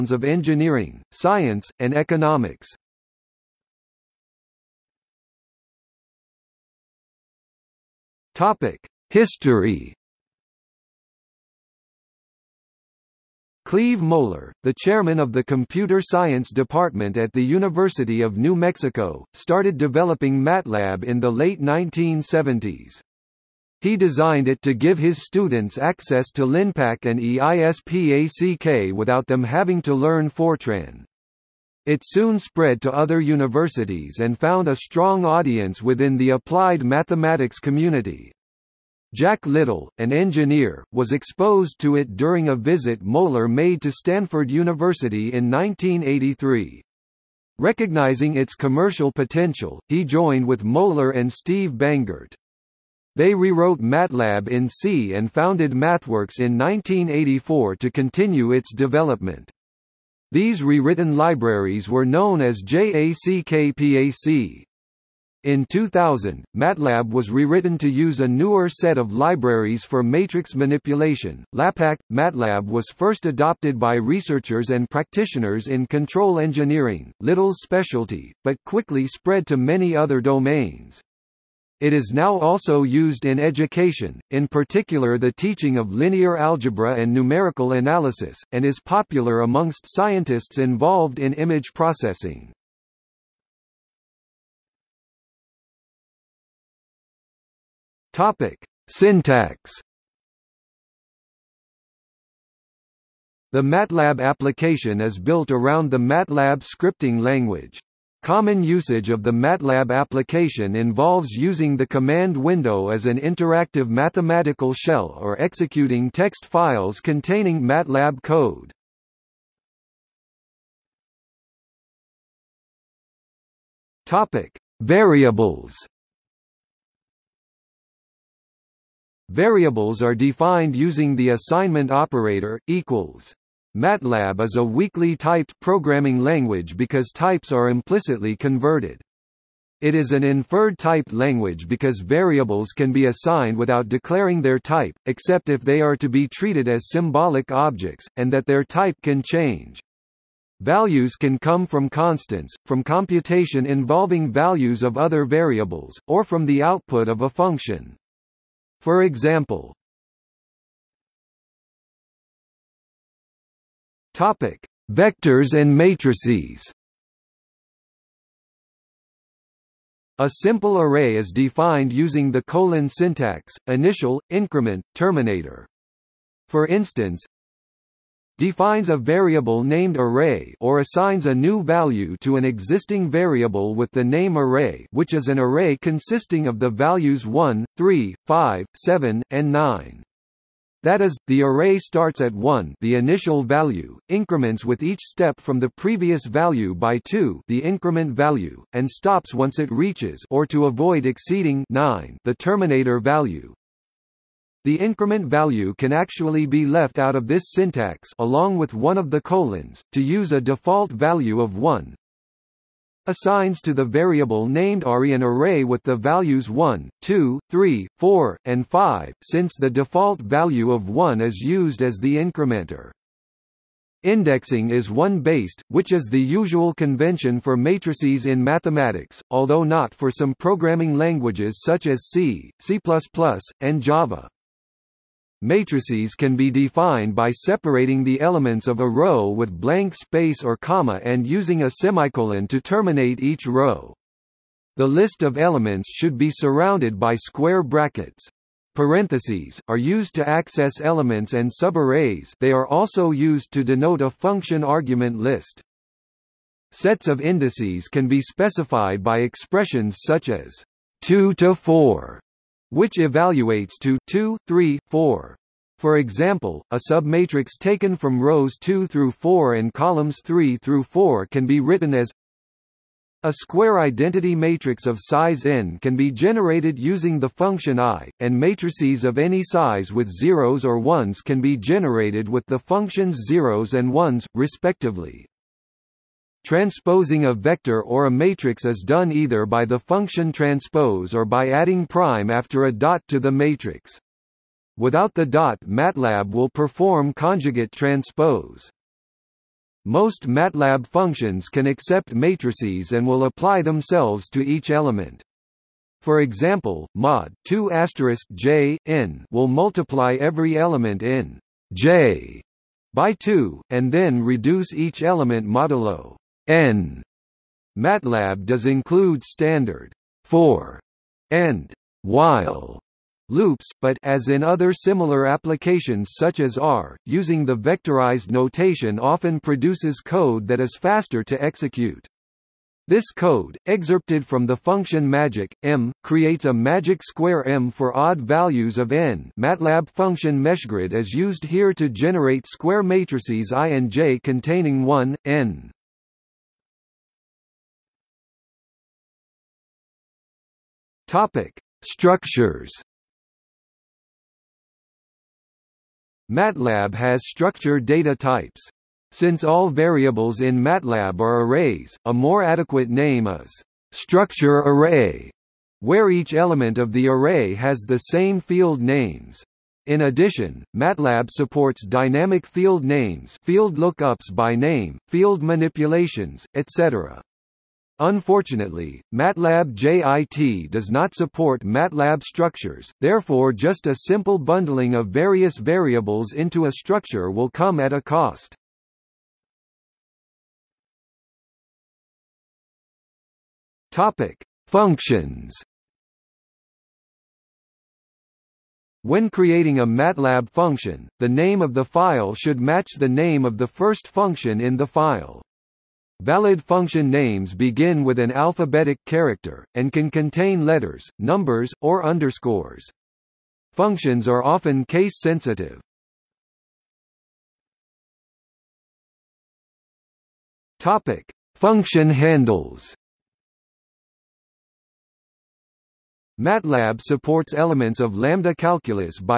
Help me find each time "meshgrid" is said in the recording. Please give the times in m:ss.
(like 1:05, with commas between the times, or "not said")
5:40.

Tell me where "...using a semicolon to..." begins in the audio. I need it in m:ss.
4:01.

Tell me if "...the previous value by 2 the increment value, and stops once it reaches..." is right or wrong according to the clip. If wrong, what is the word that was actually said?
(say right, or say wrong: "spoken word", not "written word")
right.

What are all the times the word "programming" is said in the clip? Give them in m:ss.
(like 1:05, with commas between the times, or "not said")
2:15, 3:50.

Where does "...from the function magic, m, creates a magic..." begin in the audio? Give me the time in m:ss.
5:34.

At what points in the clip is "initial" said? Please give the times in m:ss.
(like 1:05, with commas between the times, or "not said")
2:53, 3:12.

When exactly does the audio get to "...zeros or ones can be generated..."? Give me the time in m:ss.
4:40.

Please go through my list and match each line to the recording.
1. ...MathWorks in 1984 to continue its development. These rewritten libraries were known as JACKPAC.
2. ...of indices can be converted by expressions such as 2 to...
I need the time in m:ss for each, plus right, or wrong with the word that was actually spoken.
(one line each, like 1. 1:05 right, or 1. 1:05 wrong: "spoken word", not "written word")
1. 0:55 right
2. 4:17 wrong: "specified", not "converted".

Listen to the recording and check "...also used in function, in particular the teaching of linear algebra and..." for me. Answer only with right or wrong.
wrong.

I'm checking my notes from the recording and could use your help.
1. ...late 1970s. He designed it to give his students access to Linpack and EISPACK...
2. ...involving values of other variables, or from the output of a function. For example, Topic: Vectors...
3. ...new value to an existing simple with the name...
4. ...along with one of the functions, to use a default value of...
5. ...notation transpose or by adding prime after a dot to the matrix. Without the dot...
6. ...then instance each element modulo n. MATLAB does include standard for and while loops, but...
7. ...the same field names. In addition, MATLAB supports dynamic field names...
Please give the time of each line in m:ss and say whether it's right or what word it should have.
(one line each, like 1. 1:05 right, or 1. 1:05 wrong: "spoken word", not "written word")
1. 0:21 right
2. 2:33 right
3. 3:01 wrong: "variable", not "simple"
4. 3:28 wrong: "colons", not "functions"
5. 4:49 wrong: "function", not "notation"
6. 5:13 wrong: "reduce", not "instance"
7. 6:07 right.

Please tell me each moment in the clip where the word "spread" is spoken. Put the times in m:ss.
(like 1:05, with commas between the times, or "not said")
0:32, 1:19.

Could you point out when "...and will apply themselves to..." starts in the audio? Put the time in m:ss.
5:02.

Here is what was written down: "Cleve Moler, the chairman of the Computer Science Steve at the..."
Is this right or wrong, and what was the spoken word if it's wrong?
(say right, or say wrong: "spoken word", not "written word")
wrong: "Department", not "Steve".